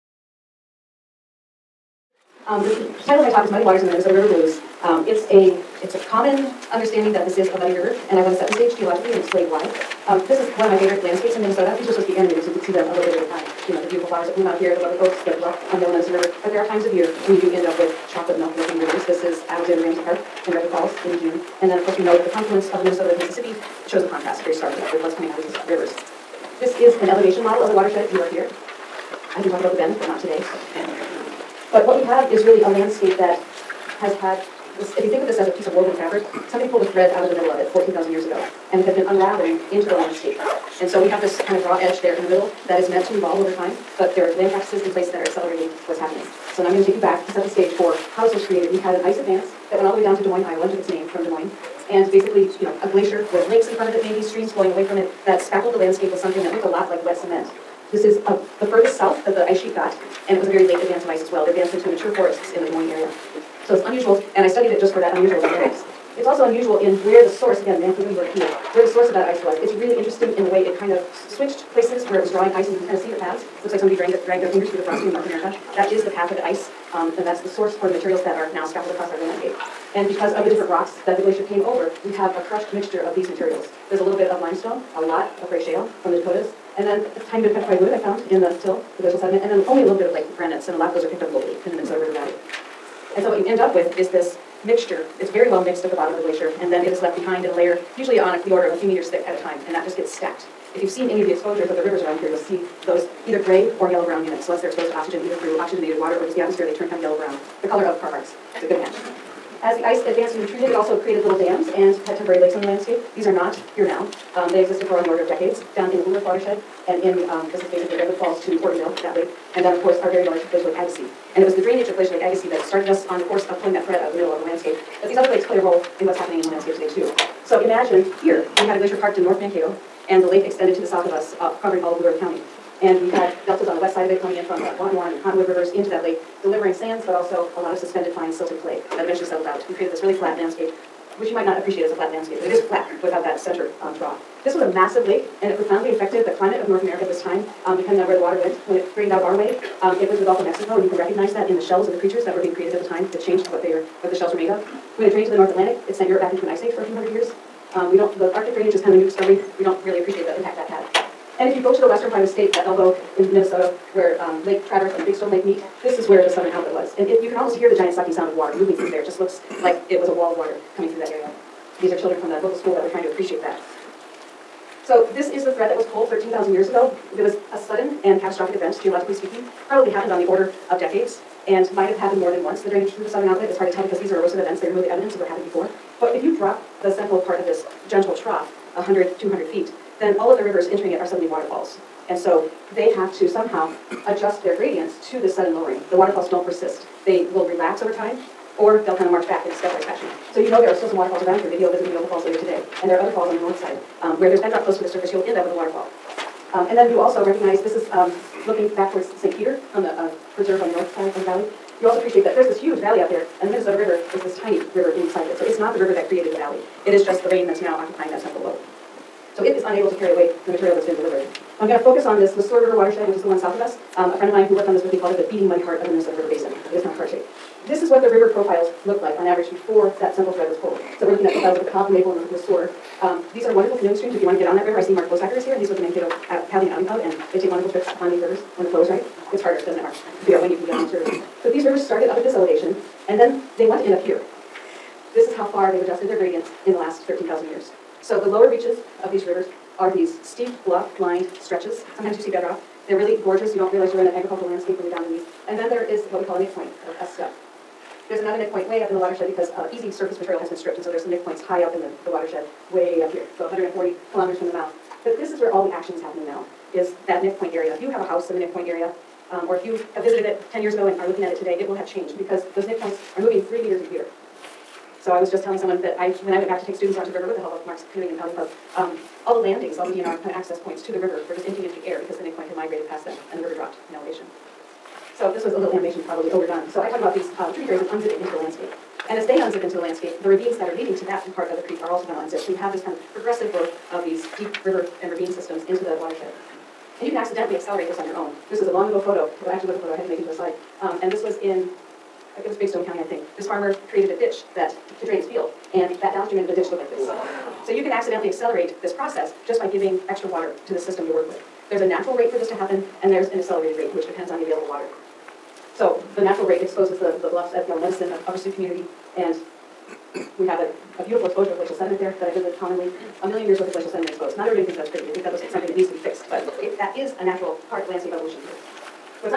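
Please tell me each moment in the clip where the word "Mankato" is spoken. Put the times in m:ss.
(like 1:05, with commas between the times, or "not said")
2:09, 3:55.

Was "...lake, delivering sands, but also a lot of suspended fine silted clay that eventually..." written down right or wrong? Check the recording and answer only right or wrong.
right.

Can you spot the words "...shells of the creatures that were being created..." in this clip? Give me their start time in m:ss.
2:31.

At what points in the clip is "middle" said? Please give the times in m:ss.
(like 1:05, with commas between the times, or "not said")
0:37, 0:42, 2:04.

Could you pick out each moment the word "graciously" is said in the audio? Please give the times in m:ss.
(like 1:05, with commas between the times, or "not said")
not said.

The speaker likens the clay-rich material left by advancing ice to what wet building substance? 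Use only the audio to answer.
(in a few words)
wet cement.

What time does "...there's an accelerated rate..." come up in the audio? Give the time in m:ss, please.
5:13.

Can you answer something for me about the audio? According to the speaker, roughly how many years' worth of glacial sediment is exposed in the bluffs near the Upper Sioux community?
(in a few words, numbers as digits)
a million years.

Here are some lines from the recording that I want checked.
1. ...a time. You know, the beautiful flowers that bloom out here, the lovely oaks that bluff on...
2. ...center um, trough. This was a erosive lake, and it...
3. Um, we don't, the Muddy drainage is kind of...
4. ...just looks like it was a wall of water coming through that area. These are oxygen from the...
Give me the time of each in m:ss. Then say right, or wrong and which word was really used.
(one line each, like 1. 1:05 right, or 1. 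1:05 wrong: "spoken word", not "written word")
1. 0:13 right
2. 2:23 wrong: "massive", not "erosive"
3. 2:37 wrong: "Arctic", not "Muddy"
4. 2:49 wrong: "children", not "oxygen".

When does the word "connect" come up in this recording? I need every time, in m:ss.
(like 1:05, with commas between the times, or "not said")
not said.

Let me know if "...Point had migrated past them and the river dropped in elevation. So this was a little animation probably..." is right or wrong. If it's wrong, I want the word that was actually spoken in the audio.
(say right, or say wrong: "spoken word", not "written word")
right.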